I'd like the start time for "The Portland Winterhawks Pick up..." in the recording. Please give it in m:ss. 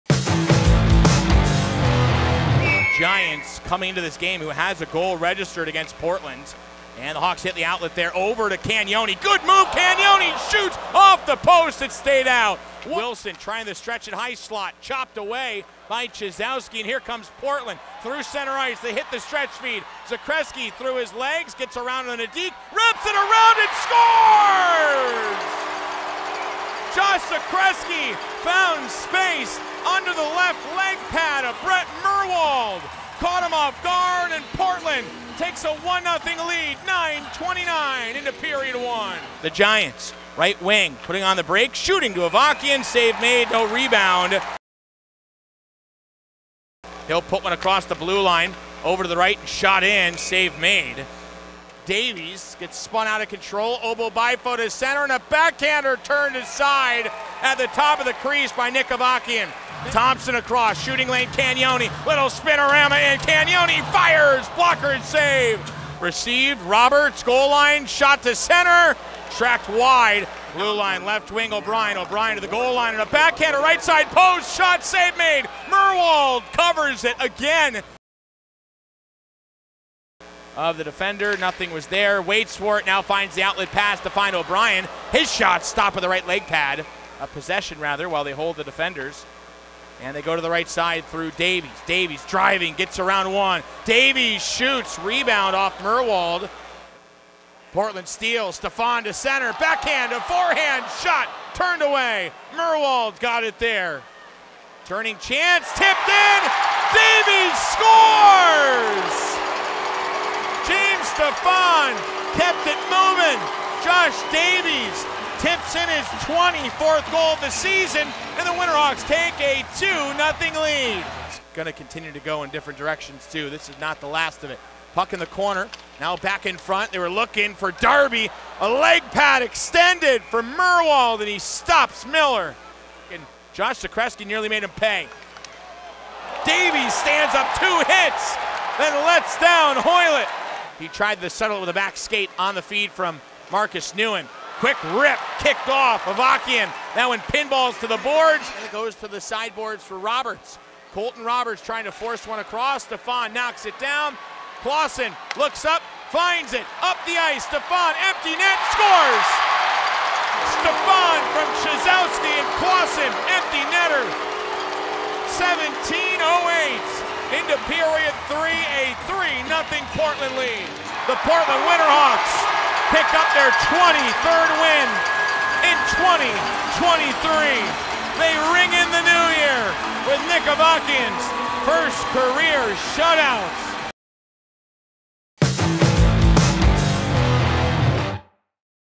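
2:51.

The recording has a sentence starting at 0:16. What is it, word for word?
And here comes Portland through center ice.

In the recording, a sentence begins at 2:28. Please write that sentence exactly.
And it goes to the sideboards for Roberts.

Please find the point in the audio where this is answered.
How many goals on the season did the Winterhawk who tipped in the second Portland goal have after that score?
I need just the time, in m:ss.
1:56.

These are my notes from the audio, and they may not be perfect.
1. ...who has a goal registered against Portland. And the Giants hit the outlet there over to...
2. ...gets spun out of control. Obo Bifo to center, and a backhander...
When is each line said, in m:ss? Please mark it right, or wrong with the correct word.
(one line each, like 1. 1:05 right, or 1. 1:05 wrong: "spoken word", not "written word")
1. 0:04 wrong: "Hawks", not "Giants"
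2. 0:52 right.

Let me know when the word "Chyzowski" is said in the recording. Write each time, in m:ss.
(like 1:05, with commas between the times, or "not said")
0:16, 2:41.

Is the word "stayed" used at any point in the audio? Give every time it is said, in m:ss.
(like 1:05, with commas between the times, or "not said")
0:11.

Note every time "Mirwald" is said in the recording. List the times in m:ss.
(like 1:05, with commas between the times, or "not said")
0:32, 1:15, 1:35, 1:42, 2:10.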